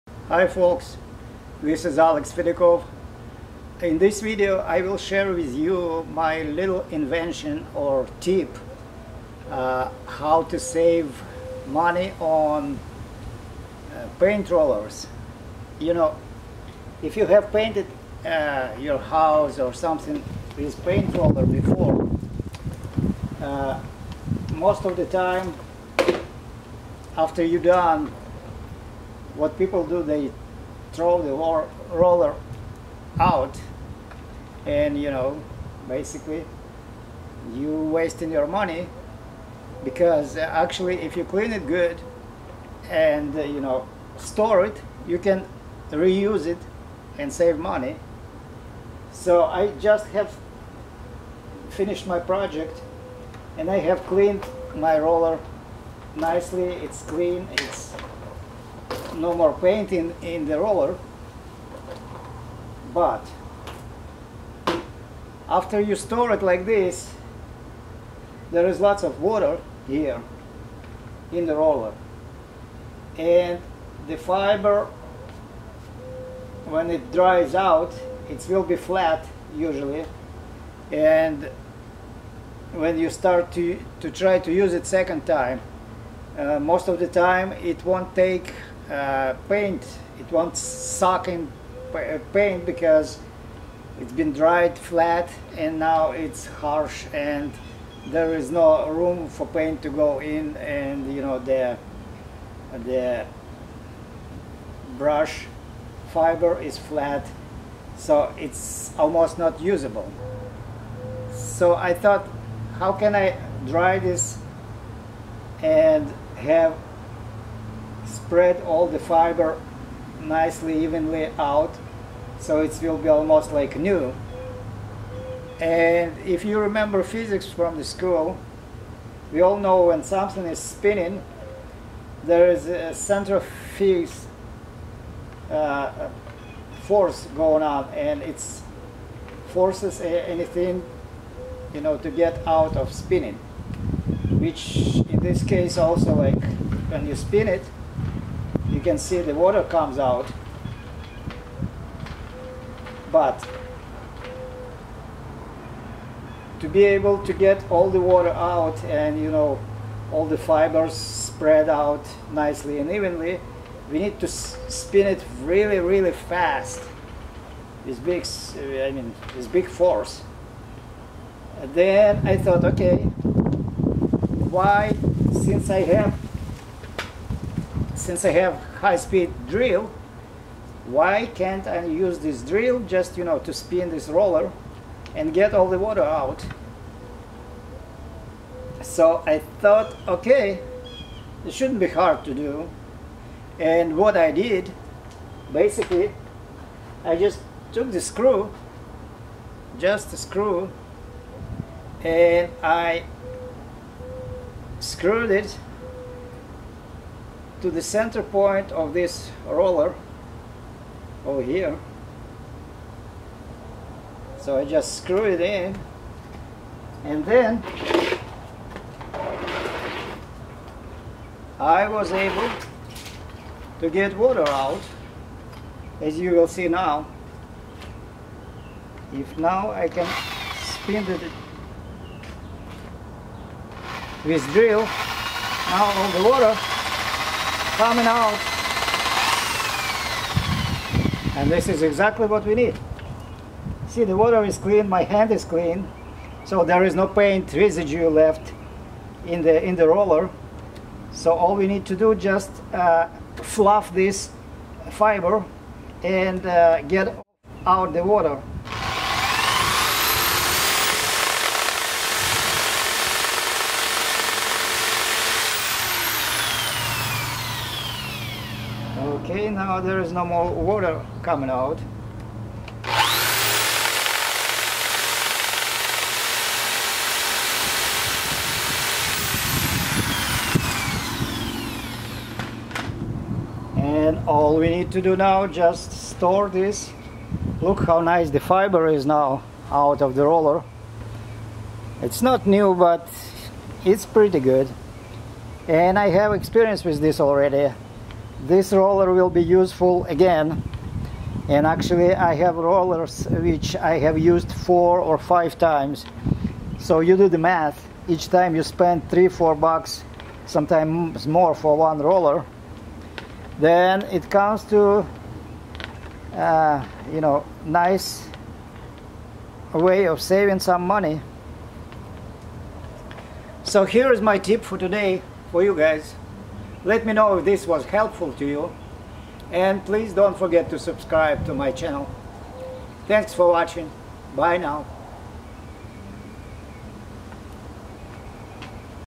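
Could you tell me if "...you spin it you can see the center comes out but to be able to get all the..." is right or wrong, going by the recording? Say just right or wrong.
wrong.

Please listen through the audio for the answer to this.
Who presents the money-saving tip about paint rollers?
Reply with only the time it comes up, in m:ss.
0:01.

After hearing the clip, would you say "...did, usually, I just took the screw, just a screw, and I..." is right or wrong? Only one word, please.
wrong.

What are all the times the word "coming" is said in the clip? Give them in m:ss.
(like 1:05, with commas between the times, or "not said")
3:57, 4:31.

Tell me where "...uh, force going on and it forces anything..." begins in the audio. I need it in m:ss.
2:15.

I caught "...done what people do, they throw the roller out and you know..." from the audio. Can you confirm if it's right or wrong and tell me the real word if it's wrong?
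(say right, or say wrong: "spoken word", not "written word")
right.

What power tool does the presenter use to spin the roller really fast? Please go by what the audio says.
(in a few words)
high-speed drill.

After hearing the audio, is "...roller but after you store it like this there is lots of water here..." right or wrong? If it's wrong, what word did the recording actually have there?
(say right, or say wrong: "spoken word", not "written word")
right.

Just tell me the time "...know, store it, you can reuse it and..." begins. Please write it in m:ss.
0:43.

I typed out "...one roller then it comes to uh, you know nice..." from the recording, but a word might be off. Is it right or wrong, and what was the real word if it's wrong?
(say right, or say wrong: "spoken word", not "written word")
right.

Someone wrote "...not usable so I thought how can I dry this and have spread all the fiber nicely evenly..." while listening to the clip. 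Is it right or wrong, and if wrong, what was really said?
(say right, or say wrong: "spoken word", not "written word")
right.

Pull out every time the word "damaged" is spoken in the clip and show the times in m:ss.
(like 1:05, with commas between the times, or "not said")
not said.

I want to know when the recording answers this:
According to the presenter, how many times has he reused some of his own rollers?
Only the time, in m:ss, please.
5:04.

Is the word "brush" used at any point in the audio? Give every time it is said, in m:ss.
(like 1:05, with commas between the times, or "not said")
1:44.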